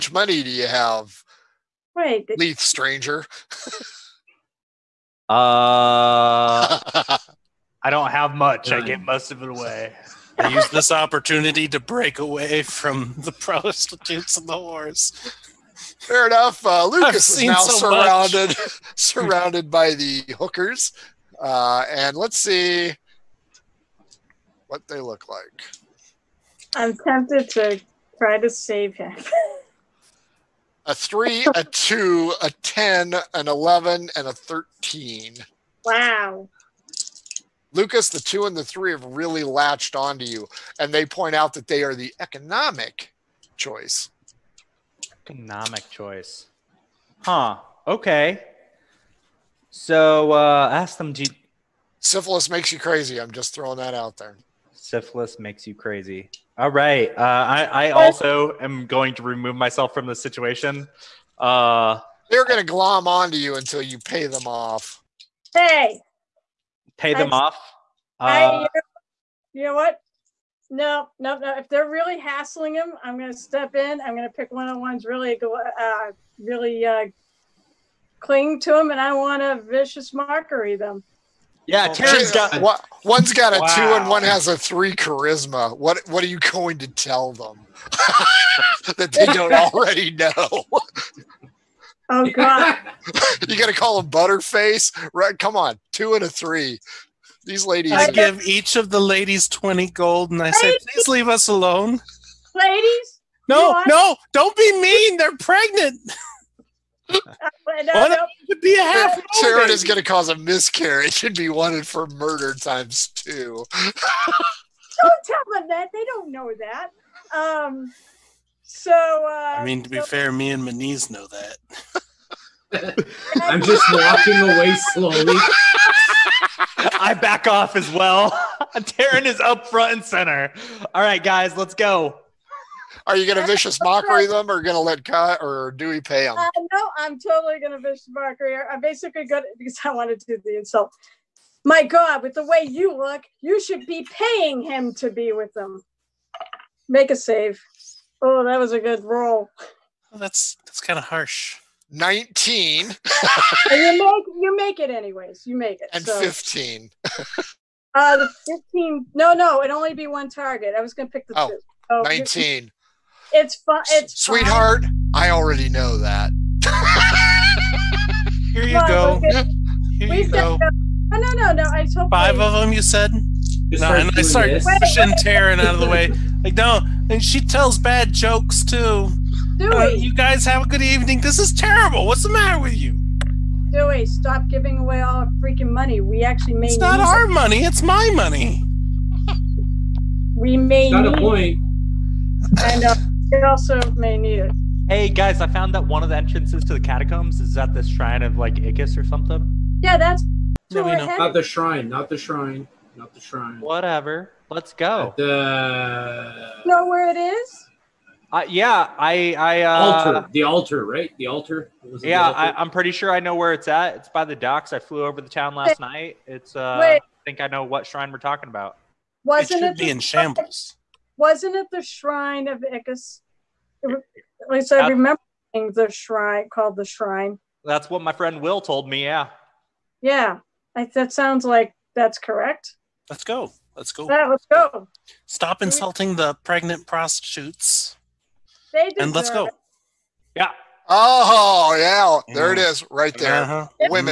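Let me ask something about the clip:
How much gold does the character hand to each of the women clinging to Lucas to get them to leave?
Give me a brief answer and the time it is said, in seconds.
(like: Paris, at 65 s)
20 gold, at 99 s.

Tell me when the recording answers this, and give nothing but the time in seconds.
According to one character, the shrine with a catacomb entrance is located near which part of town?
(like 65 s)
214 s.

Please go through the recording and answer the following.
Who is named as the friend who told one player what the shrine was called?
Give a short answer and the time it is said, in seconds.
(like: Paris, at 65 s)
Will, at 228 s.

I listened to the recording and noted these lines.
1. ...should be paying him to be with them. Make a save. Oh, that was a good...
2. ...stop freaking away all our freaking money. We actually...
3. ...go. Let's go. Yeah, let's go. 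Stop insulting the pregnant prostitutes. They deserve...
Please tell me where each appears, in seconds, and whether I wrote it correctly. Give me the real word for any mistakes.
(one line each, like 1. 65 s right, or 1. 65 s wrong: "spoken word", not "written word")
1. 143 s right
2. 184 s wrong: "giving", not "freaking"
3. 233 s right.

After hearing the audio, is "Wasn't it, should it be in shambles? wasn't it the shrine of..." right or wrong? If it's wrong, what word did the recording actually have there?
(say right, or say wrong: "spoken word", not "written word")
right.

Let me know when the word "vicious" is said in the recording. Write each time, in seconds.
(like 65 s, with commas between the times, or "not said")
79 s, 133 s, 137 s.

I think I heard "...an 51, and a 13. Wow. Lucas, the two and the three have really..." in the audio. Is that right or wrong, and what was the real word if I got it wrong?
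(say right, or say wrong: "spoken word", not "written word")
wrong: "11", not "51".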